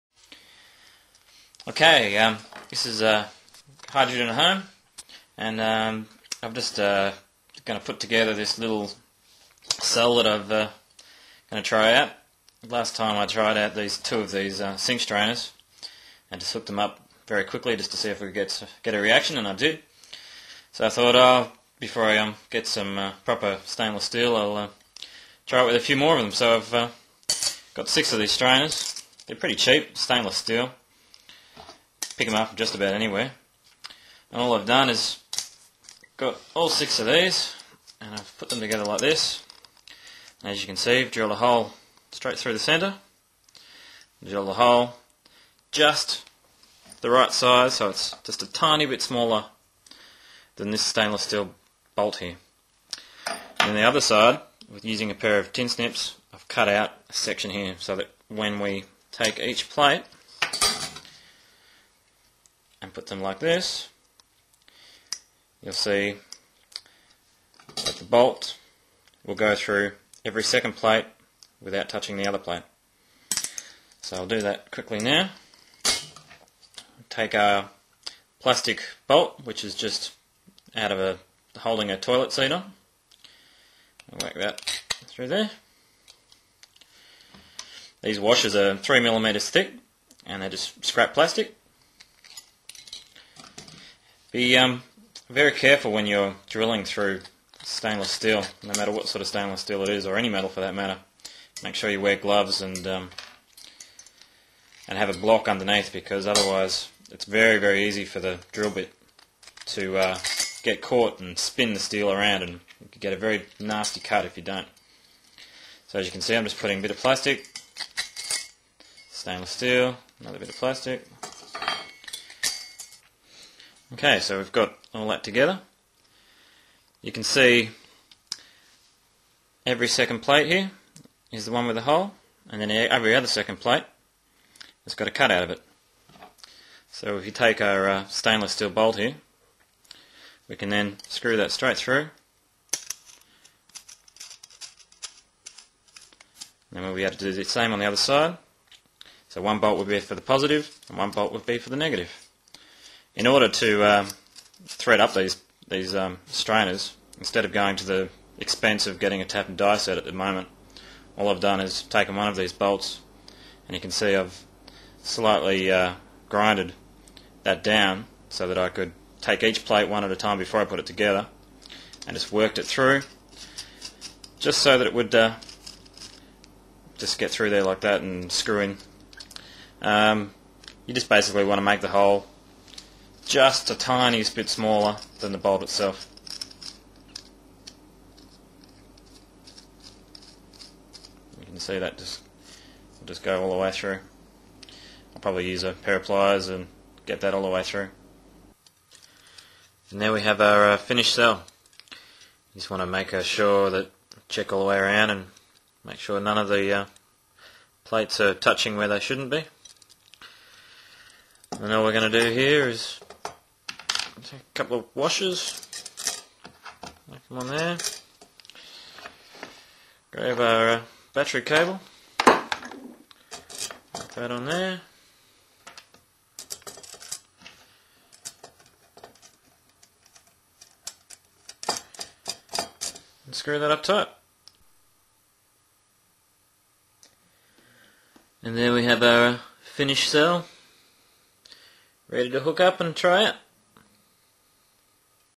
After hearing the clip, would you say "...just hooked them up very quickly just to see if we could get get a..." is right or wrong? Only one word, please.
right.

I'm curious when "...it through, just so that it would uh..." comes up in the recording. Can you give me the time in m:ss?
2:52.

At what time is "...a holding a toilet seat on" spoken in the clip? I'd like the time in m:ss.
1:20.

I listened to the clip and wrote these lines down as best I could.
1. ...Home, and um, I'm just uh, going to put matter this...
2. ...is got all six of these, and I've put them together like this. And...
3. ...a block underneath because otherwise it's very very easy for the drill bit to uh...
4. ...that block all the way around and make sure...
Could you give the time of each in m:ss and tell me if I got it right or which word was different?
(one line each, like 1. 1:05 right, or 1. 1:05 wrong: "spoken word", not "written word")
1. 0:04 wrong: "together", not "matter"
2. 0:34 right
3. 1:45 right
4. 3:23 wrong: "check", not "block".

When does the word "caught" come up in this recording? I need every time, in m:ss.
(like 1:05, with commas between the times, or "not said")
1:50.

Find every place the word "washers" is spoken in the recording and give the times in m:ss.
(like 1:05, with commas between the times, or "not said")
1:28, 3:34.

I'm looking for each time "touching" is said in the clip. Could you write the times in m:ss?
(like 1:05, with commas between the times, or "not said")
1:11, 3:28.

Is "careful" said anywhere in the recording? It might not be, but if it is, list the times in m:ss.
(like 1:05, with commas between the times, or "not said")
1:35.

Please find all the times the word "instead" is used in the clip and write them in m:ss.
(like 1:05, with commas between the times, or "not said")
2:37.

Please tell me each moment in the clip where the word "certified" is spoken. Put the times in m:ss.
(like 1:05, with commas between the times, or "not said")
not said.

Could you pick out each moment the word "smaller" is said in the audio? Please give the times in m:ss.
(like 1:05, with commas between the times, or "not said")
0:49, 3:04.